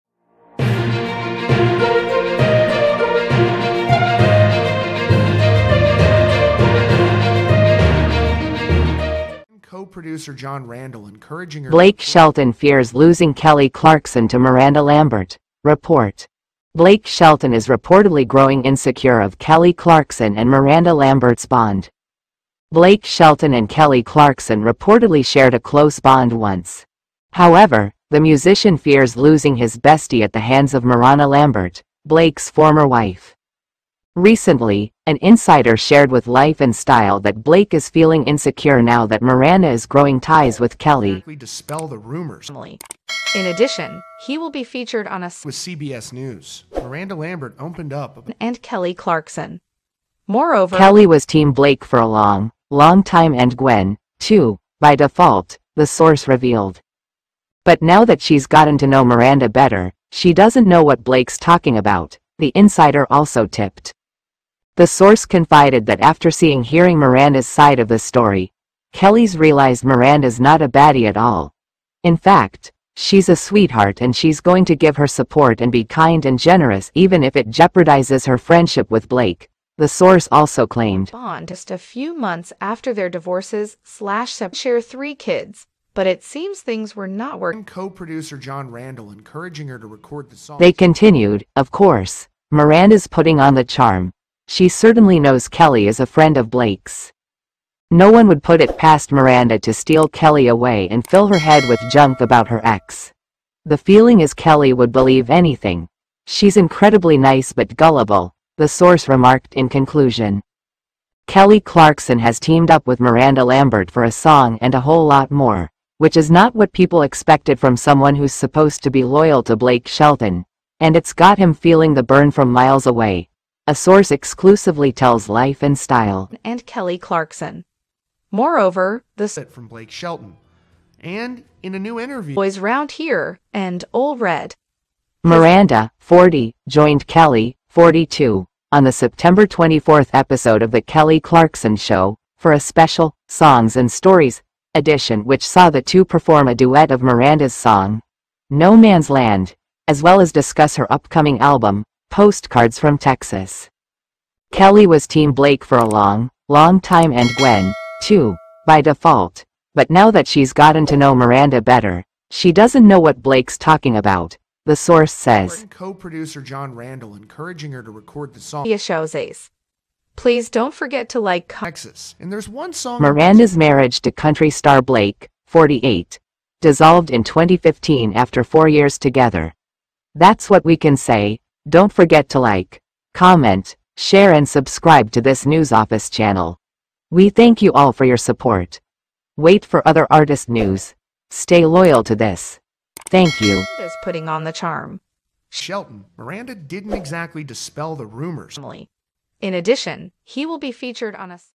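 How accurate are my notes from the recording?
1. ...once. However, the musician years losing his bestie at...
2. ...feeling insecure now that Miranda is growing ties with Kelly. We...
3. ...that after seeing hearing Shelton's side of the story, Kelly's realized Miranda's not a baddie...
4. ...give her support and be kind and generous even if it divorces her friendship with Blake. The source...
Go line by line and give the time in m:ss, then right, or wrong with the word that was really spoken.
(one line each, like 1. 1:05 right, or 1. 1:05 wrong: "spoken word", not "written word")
1. 0:26 wrong: "fears", not "years"
2. 0:37 right
3. 1:05 wrong: "Miranda", not "Shelton"
4. 1:14 wrong: "jeopardizes", not "divorces".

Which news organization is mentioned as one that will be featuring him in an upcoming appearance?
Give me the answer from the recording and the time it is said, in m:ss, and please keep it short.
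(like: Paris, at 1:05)
CBS News, at 0:45.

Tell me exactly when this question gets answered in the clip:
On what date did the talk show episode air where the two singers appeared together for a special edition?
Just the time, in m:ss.
2:18.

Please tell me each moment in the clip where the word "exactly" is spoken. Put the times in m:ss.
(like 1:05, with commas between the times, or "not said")
3:16.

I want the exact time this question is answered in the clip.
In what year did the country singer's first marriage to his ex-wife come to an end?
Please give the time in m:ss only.
2:57.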